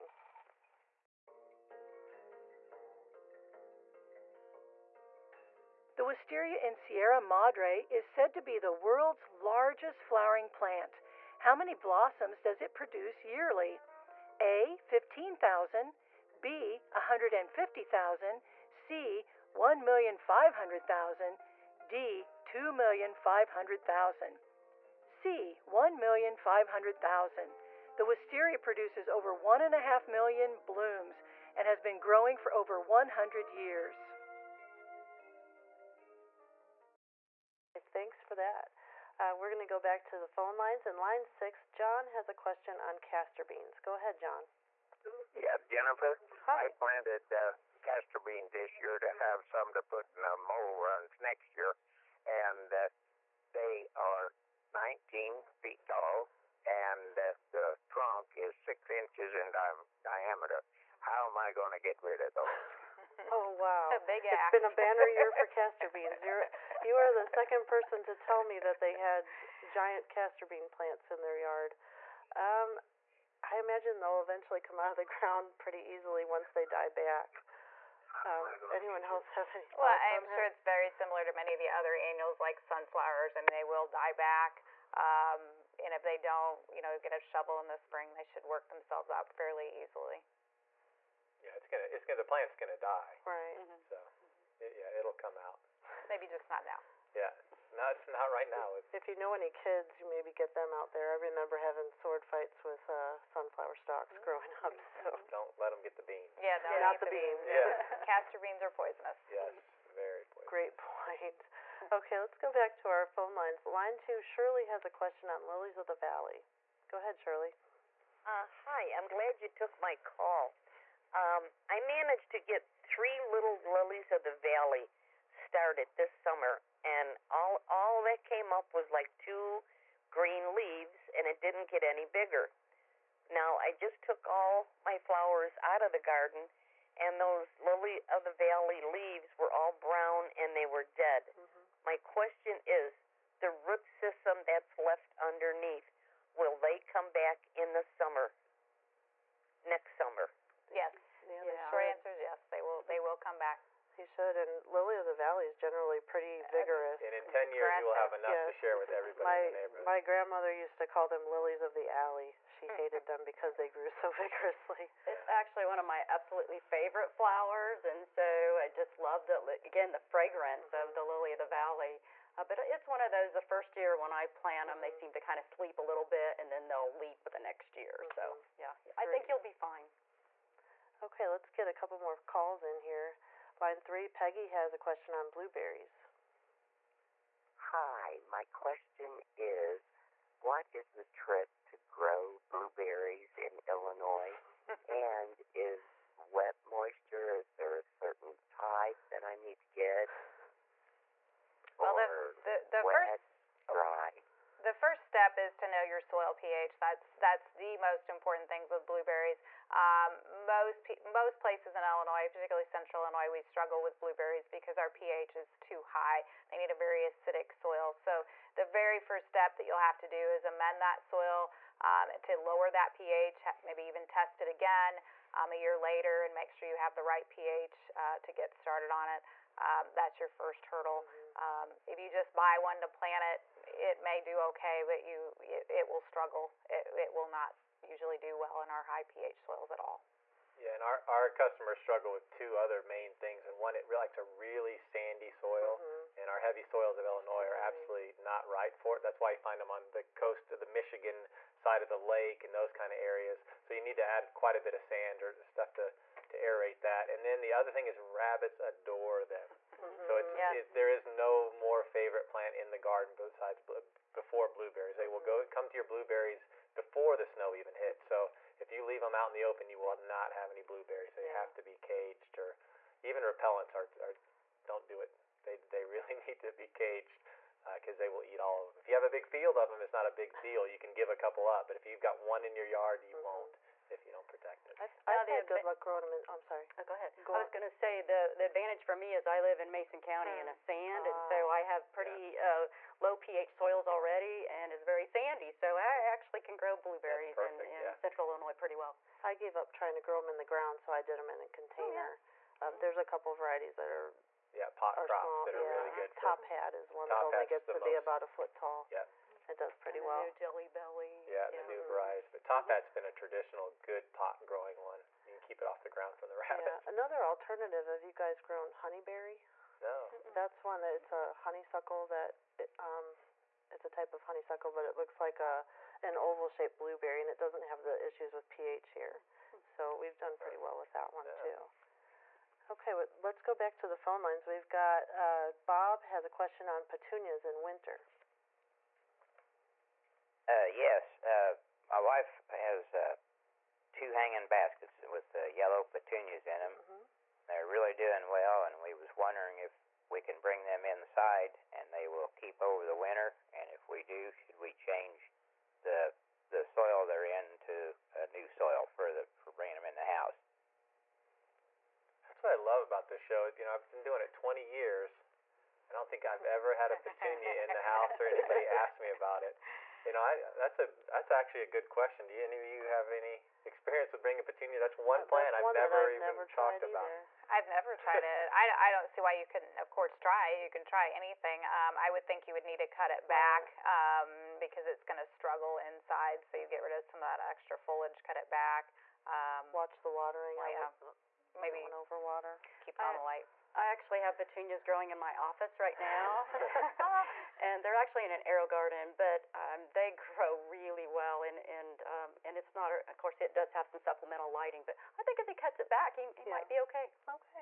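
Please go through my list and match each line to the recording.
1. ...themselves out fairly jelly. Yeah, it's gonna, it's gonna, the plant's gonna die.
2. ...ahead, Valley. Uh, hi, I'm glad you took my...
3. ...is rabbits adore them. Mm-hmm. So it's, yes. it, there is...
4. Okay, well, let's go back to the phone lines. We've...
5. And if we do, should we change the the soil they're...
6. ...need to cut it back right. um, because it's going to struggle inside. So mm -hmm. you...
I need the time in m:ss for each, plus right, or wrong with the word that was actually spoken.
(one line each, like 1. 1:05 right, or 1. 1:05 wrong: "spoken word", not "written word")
1. 1:28 wrong: "easily", not "jelly"
2. 1:56 wrong: "Shirley", not "Valley"
3. 4:17 right
4. 5:32 right
5. 5:53 right
6. 6:22 right.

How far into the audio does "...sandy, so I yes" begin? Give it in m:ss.
4:55.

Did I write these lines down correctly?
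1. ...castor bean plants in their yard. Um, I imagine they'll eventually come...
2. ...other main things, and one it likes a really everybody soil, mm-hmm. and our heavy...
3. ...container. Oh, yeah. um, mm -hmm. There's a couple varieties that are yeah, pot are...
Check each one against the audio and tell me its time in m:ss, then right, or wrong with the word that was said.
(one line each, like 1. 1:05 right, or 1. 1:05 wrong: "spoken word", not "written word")
1. 1:10 right
2. 4:02 wrong: "sandy", not "everybody"
3. 5:01 right.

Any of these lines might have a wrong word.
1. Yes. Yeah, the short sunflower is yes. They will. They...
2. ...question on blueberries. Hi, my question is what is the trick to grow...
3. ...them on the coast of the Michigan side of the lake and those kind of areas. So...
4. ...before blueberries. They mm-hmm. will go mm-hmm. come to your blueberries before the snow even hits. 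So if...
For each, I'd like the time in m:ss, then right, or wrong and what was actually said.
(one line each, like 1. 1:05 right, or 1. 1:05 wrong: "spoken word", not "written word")
1. 2:30 wrong: "answer", not "sunflower"
2. 3:04 right
3. 4:09 right
4. 4:24 right.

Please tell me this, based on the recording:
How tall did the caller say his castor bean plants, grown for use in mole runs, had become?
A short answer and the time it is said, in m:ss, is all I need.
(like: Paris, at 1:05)
19 feet, at 0:54.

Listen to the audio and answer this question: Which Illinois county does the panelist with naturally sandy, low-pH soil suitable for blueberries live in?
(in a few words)
Mason County.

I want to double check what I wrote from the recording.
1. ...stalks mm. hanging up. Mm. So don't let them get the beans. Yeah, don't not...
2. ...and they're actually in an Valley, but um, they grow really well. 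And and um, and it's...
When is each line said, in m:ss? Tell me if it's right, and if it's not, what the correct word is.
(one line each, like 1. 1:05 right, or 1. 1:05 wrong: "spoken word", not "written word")
1. 1:43 wrong: "growing", not "hanging"
2. 6:37 wrong: "AeroGarden", not "Valley".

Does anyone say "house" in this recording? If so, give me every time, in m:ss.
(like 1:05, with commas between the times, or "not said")
6:00, 6:07.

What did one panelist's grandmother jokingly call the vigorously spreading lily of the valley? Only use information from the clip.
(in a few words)
lilies of the alley.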